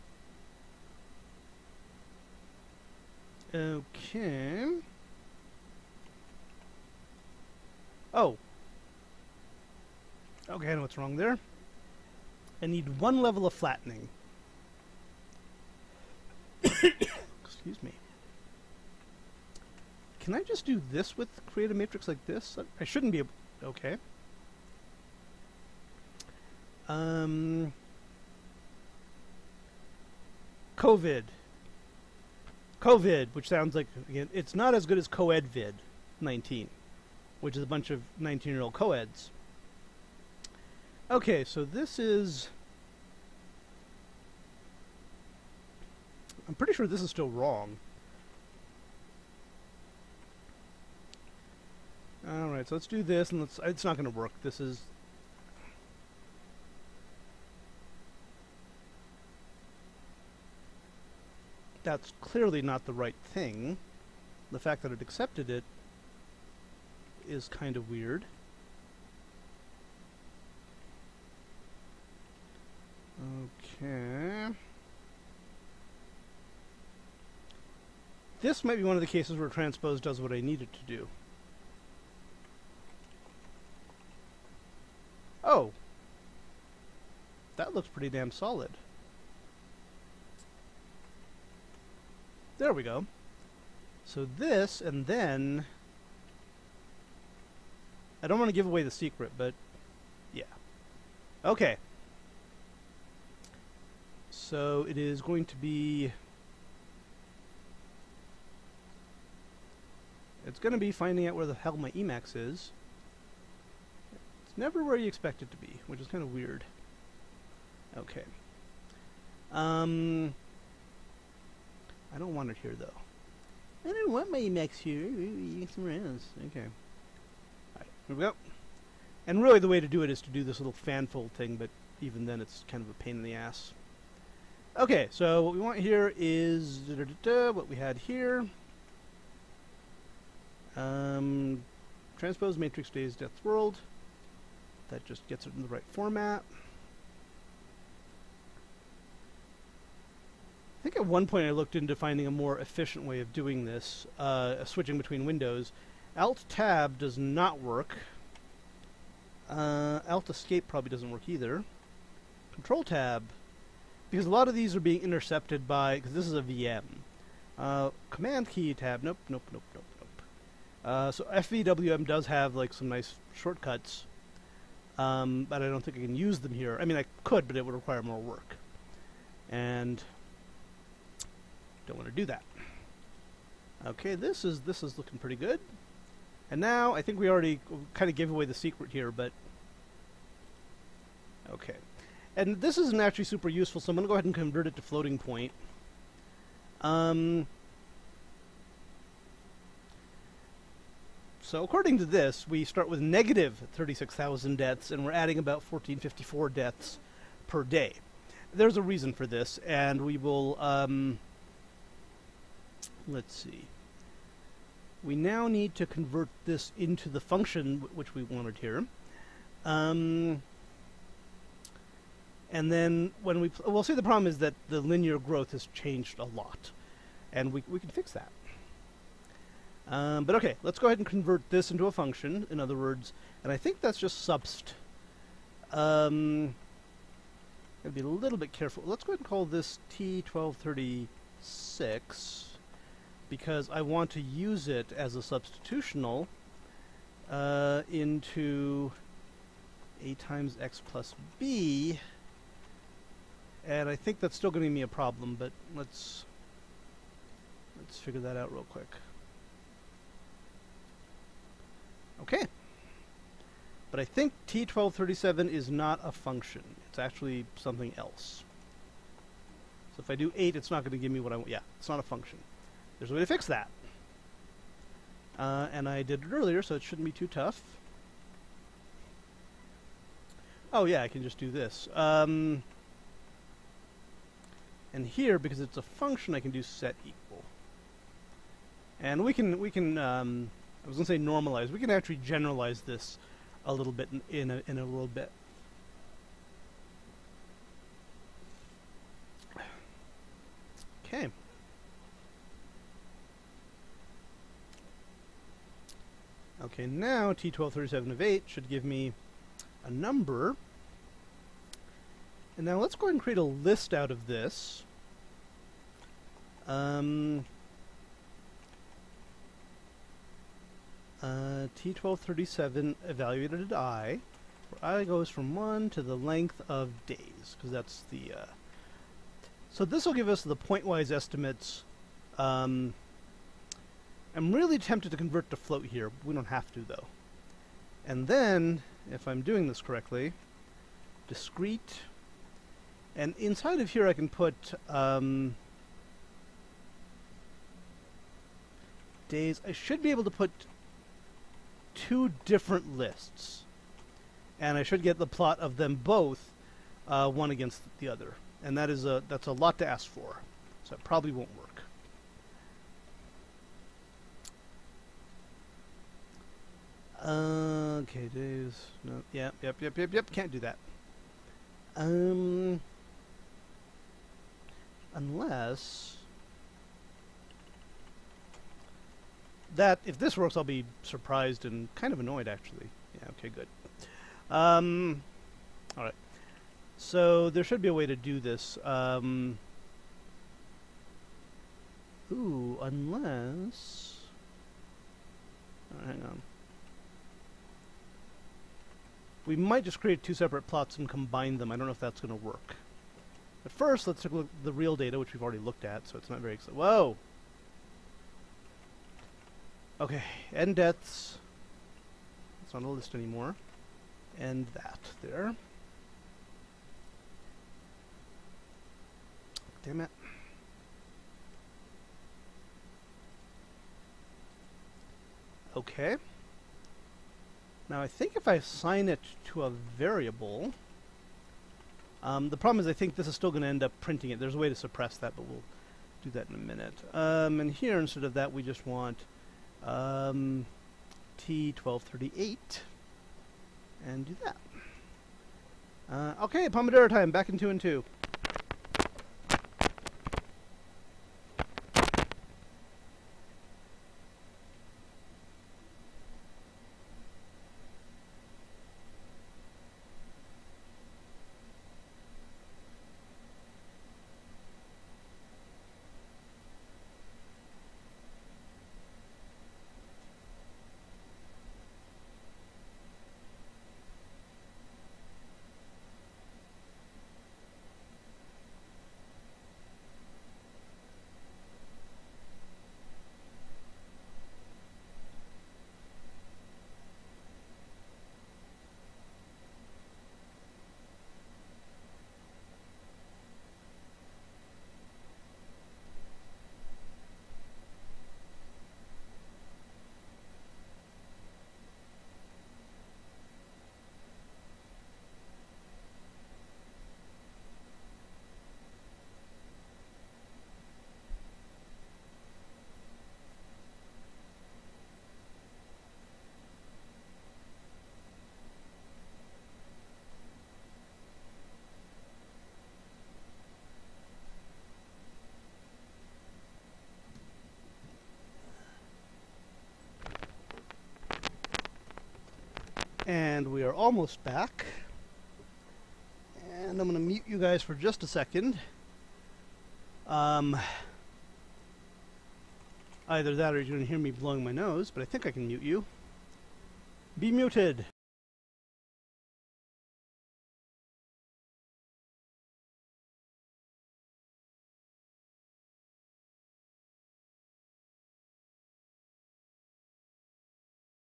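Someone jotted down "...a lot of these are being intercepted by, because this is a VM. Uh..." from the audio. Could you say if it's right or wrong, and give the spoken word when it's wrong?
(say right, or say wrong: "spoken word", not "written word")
right.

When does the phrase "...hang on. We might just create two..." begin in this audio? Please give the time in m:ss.
6:36.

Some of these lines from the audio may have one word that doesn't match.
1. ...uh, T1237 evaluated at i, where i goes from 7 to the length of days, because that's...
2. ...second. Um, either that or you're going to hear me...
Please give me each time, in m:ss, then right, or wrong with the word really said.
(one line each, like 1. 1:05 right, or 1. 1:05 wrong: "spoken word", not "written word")
1. 5:21 wrong: "1", not "7"
2. 8:58 right.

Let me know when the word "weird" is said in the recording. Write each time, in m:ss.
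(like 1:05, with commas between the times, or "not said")
1:07, 1:56.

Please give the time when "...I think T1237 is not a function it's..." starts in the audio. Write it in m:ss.
4:23.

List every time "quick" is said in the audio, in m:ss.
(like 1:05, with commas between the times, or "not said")
4:18.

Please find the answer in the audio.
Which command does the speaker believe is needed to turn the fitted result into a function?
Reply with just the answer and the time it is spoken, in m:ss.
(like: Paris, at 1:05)
subst, at 3:54.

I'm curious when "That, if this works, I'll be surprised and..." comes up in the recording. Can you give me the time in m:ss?
6:19.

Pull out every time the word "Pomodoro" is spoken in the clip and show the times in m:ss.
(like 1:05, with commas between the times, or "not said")
7:26.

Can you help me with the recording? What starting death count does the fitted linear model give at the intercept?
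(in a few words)
-36,000.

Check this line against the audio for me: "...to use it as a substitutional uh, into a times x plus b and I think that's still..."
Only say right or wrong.
right.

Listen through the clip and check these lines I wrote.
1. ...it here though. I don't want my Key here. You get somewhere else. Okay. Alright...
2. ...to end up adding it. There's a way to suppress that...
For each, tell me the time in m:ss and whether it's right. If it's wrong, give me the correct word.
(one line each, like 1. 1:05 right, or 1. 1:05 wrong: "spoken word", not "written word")
1. 2:02 wrong: "Emacs", not "Key"
2. 7:13 wrong: "printing", not "adding".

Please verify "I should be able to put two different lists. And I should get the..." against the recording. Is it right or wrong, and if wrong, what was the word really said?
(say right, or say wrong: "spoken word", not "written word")
right.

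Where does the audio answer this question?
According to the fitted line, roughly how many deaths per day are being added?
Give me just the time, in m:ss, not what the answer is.
3:25.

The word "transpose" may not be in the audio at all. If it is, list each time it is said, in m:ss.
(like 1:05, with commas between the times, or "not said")
1:19, 2:22.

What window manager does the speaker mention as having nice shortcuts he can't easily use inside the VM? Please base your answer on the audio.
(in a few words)
FVWM.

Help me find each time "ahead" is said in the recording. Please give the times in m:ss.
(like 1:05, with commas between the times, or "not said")
3:14, 3:50, 3:59, 5:13.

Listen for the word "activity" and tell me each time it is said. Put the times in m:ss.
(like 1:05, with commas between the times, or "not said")
not said.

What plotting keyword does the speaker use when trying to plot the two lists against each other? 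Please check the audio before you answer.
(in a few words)
discrete.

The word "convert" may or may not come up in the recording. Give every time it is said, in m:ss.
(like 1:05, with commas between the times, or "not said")
3:14, 3:35, 3:51, 5:35.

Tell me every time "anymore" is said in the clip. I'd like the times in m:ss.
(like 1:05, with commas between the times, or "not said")
6:53.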